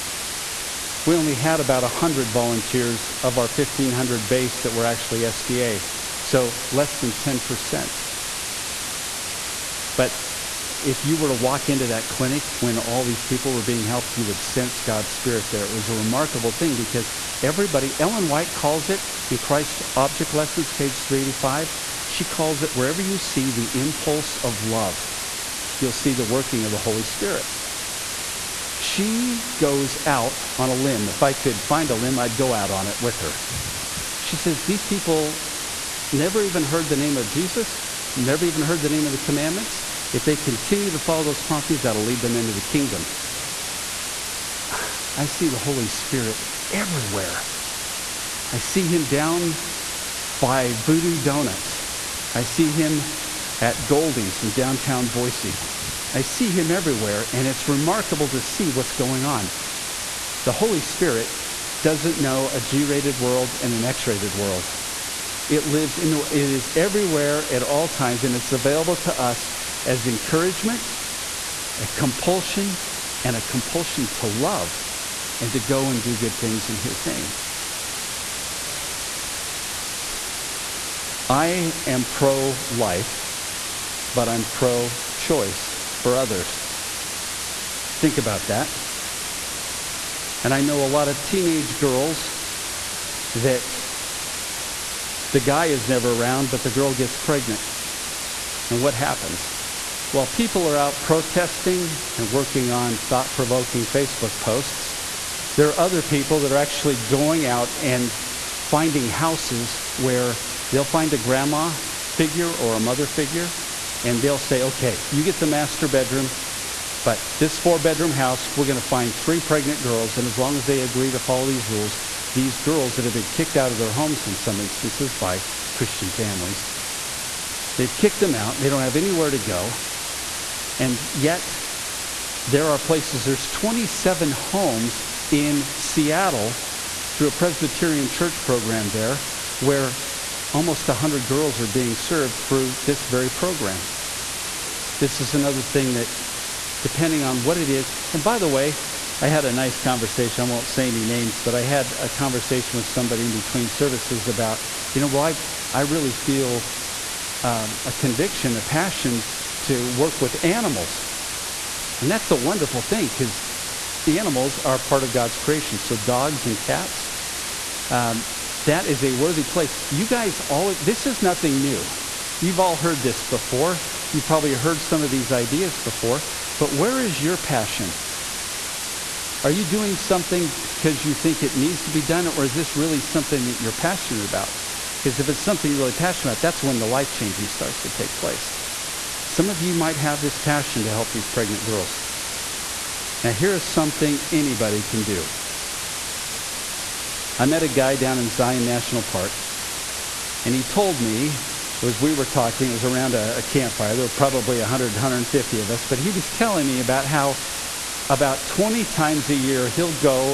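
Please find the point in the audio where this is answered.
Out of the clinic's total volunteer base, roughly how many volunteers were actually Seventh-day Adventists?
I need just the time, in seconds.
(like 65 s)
1 s.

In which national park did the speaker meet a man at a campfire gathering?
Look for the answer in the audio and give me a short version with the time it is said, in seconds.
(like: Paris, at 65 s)
Zion National Park, at 198 s.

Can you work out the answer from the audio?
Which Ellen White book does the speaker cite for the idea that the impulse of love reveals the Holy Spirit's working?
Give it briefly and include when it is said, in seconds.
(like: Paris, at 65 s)
Christ's Object Lessons, at 19 s.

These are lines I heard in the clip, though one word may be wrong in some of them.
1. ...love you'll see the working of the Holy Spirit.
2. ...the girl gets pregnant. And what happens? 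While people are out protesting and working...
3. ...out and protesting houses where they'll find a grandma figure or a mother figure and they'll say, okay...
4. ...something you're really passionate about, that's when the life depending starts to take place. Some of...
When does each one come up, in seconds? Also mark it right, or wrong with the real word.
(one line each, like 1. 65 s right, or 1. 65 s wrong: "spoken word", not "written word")
1. 24 s right
2. 96 s right
3. 107 s wrong: "finding", not "protesting"
4. 185 s wrong: "changing", not "depending".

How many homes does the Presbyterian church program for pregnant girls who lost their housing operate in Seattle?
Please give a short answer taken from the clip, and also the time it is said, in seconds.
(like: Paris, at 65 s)
27, at 133 s.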